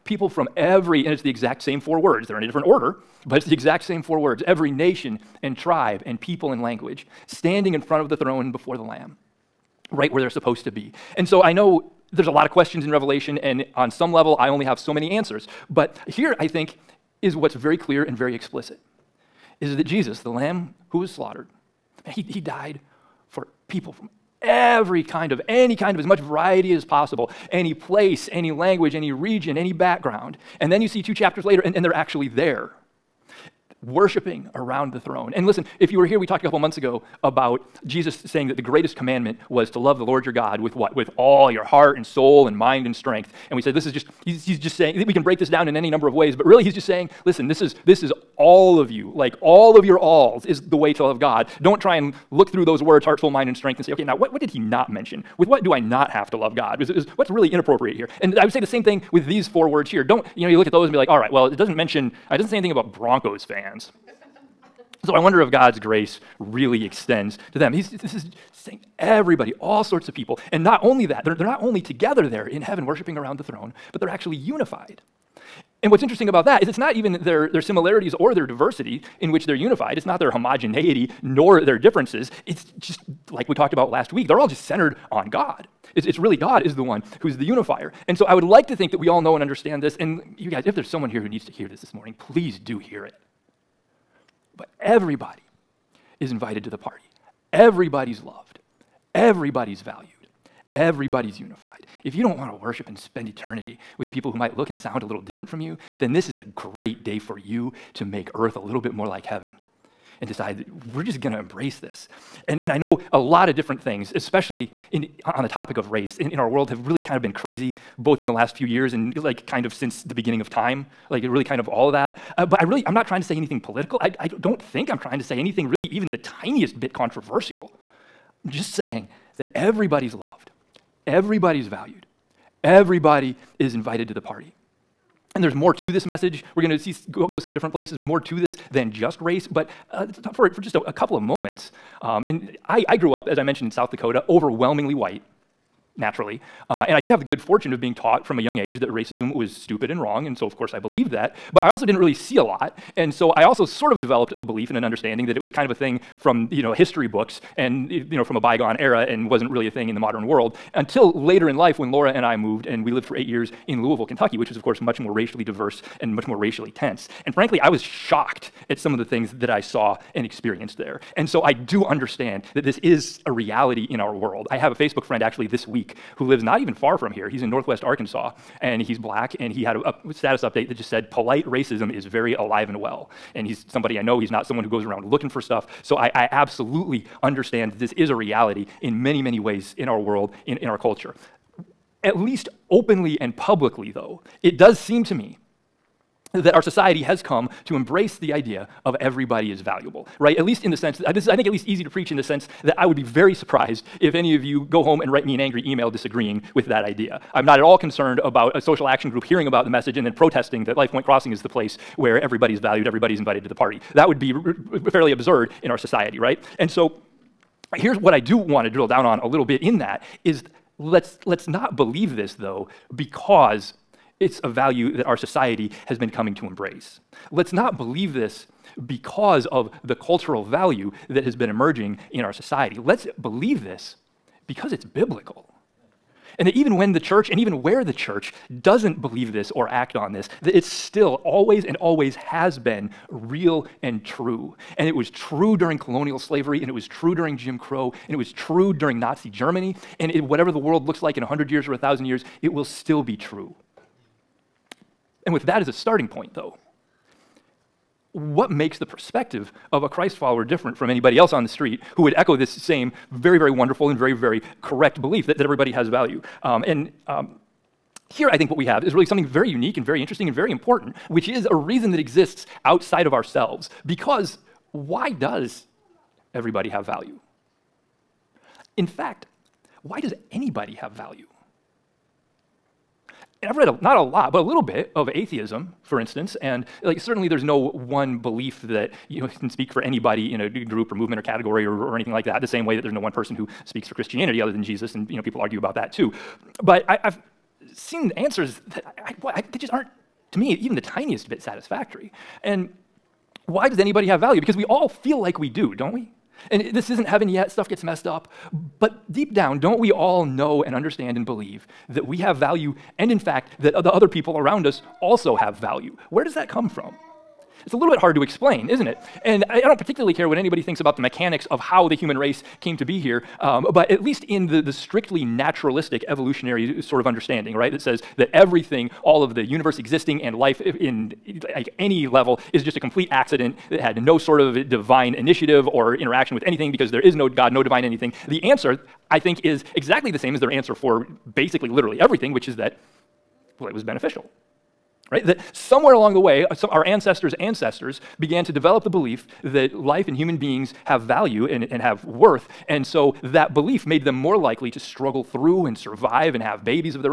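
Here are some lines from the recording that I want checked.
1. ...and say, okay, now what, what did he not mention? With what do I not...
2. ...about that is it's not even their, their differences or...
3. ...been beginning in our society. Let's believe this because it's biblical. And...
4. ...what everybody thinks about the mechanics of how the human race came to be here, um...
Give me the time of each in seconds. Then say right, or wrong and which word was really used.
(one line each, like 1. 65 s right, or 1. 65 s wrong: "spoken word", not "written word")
1. 53 s right
2. 76 s wrong: "similarities", not "differences"
3. 231 s wrong: "emerging", not "beginning"
4. 320 s wrong: "anybody", not "everybody".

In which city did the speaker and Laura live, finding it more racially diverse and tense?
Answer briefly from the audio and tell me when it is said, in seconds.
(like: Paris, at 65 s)
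Louisville, Kentucky, at 163 s.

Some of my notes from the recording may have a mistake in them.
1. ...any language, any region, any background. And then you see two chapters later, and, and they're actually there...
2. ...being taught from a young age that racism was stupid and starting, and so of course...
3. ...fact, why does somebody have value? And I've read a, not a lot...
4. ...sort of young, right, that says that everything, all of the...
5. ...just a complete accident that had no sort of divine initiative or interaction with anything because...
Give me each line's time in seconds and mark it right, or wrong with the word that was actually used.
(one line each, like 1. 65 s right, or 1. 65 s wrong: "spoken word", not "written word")
1. 28 s right
2. 147 s wrong: "wrong", not "starting"
3. 278 s wrong: "anybody", not "somebody"
4. 326 s wrong: "understanding", not "young"
5. 332 s right.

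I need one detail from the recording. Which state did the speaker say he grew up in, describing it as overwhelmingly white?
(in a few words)
South Dakota.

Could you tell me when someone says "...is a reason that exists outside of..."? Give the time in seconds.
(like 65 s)
271 s.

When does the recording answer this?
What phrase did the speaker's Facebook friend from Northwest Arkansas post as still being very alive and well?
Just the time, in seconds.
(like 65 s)
181 s.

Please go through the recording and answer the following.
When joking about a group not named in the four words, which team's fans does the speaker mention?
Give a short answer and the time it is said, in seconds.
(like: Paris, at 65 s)
Broncos fans, at 62 s.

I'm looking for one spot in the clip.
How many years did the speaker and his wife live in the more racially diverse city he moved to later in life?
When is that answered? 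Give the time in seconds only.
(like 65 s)
163 s.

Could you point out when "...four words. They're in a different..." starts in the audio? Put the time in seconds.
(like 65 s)
1 s.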